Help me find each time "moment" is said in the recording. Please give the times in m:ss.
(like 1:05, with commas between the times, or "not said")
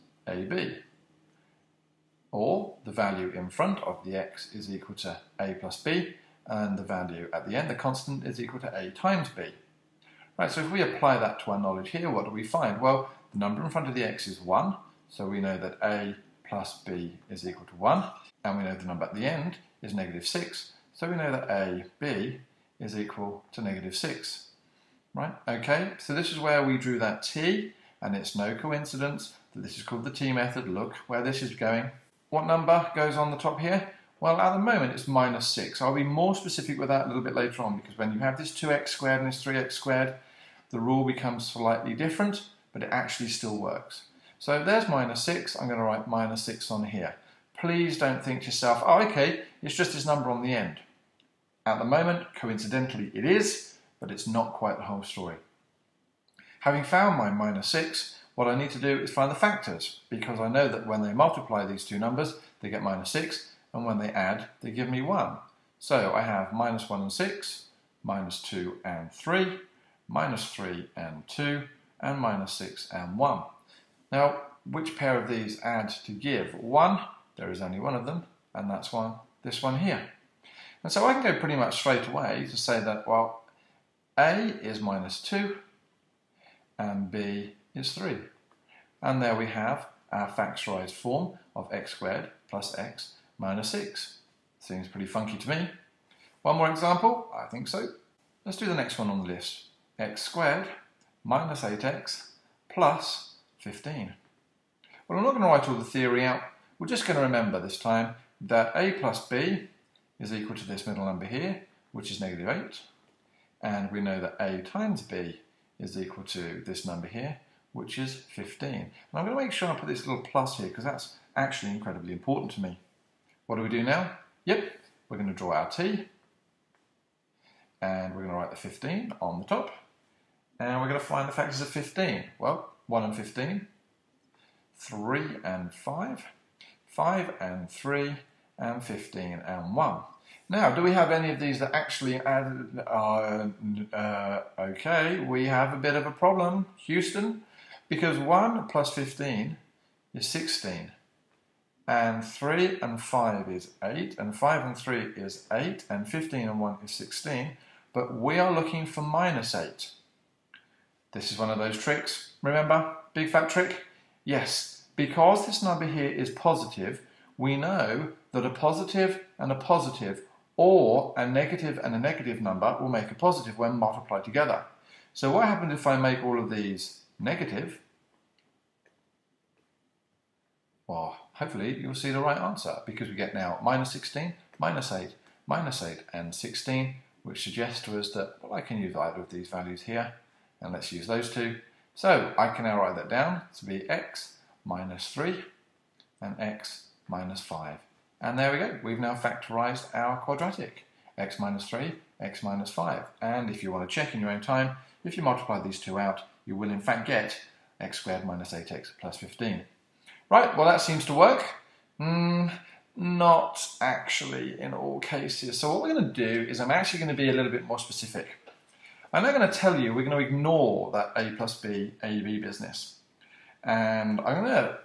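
0:34, 0:51.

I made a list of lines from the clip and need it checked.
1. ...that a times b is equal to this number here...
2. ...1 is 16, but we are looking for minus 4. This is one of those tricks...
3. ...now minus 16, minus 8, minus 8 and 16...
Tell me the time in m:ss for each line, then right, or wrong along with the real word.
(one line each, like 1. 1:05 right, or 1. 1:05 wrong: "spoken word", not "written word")
1. 1:54 right
2. 2:36 wrong: "8", not "4"
3. 3:03 right.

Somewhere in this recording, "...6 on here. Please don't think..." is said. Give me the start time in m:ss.
0:46.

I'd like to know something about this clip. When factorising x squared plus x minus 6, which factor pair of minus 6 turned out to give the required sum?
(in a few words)
-2 and 3.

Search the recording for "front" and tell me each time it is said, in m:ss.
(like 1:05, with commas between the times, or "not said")
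0:03, 0:13.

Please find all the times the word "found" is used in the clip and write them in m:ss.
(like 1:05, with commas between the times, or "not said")
0:56.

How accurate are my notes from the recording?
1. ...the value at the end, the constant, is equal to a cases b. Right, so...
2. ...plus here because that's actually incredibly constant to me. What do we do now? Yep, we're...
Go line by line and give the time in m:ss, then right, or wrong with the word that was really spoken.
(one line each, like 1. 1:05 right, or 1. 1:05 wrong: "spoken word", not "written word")
1. 0:06 wrong: "times", not "cases"
2. 2:00 wrong: "important", not "constant".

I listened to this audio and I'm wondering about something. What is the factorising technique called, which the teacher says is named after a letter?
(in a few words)
T method.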